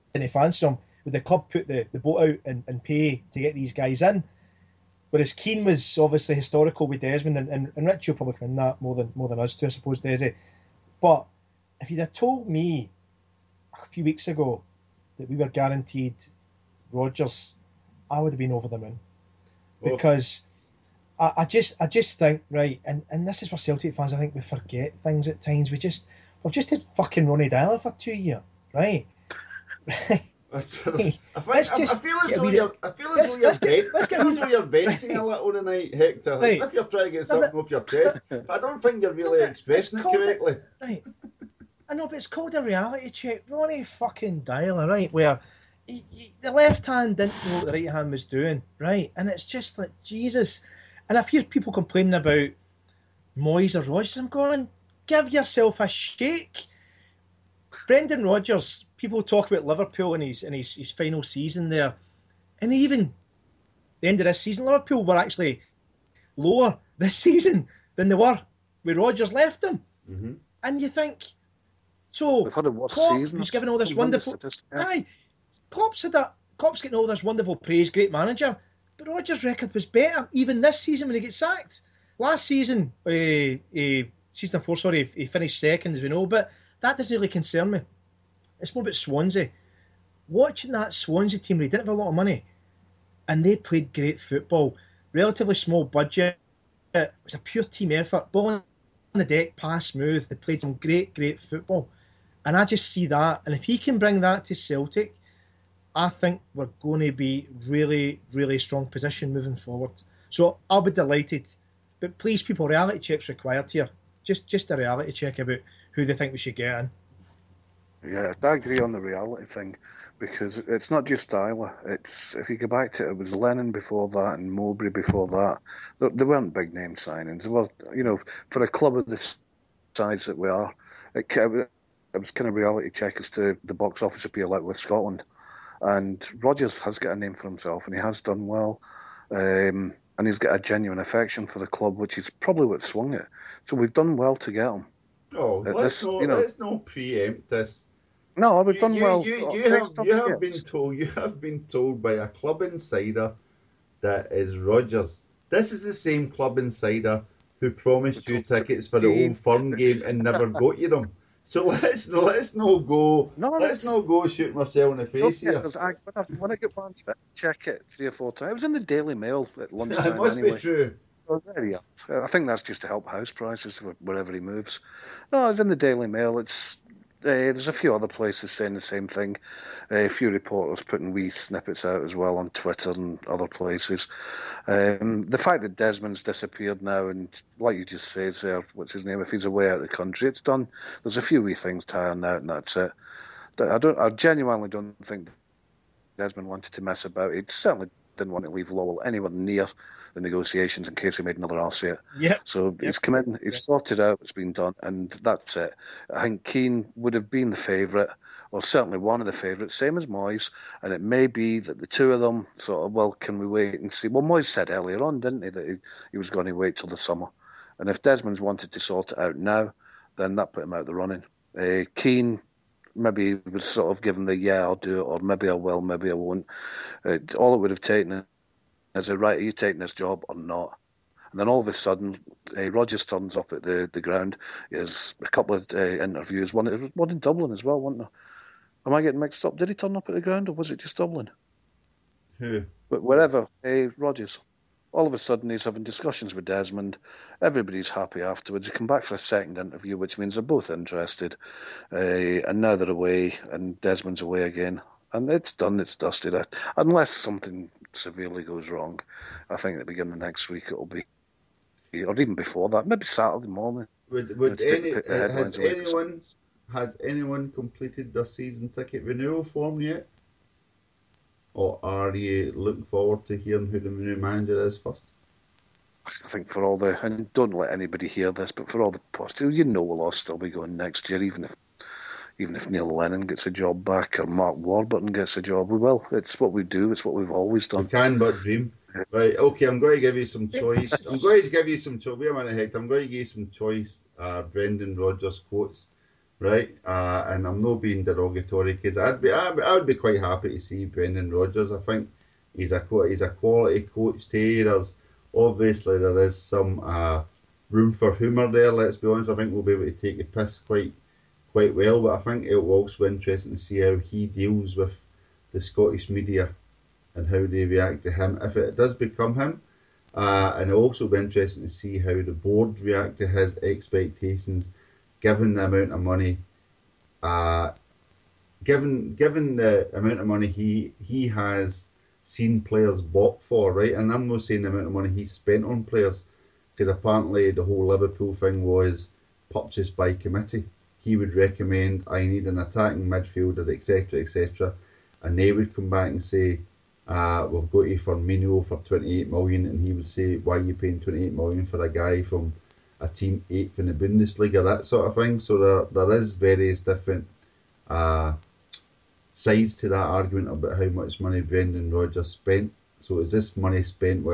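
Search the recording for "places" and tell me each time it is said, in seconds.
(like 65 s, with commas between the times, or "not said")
178 s, 183 s.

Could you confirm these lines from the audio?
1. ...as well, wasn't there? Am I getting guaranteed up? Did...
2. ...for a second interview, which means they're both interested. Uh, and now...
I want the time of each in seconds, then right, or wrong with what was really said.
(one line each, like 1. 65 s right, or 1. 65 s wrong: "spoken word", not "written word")
1. 237 s wrong: "mixed", not "guaranteed"
2. 249 s right.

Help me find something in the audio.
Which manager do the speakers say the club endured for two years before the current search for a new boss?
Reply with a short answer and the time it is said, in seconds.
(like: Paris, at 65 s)
Ronnie Deila, at 27 s.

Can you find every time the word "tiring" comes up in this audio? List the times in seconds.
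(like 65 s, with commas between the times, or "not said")
191 s.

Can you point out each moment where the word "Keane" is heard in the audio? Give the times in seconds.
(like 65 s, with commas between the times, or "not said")
5 s, 206 s, 221 s.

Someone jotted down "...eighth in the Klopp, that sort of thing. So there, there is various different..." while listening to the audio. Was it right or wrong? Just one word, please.
wrong.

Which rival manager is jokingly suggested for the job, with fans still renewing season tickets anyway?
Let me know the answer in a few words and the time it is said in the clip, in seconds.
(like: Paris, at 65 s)
Mark Warburton, at 284 s.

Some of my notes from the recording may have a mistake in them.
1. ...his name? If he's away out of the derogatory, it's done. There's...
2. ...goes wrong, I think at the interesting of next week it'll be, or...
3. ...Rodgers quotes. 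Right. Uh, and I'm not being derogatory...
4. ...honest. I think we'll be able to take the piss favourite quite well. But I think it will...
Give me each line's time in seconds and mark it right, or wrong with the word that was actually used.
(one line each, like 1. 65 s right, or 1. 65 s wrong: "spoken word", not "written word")
1. 188 s wrong: "country", not "derogatory"
2. 258 s wrong: "beginning", not "interesting"
3. 294 s right
4. 309 s wrong: "quite", not "favourite".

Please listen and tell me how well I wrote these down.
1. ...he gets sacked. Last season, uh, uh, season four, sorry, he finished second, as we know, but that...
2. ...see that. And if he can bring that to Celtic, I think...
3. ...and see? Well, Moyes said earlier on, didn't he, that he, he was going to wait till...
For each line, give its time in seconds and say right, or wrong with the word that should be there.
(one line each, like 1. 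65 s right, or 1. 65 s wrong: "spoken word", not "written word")
1. 81 s right
2. 102 s right
3. 213 s right.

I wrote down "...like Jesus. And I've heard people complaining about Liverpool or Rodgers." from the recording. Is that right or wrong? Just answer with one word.
wrong.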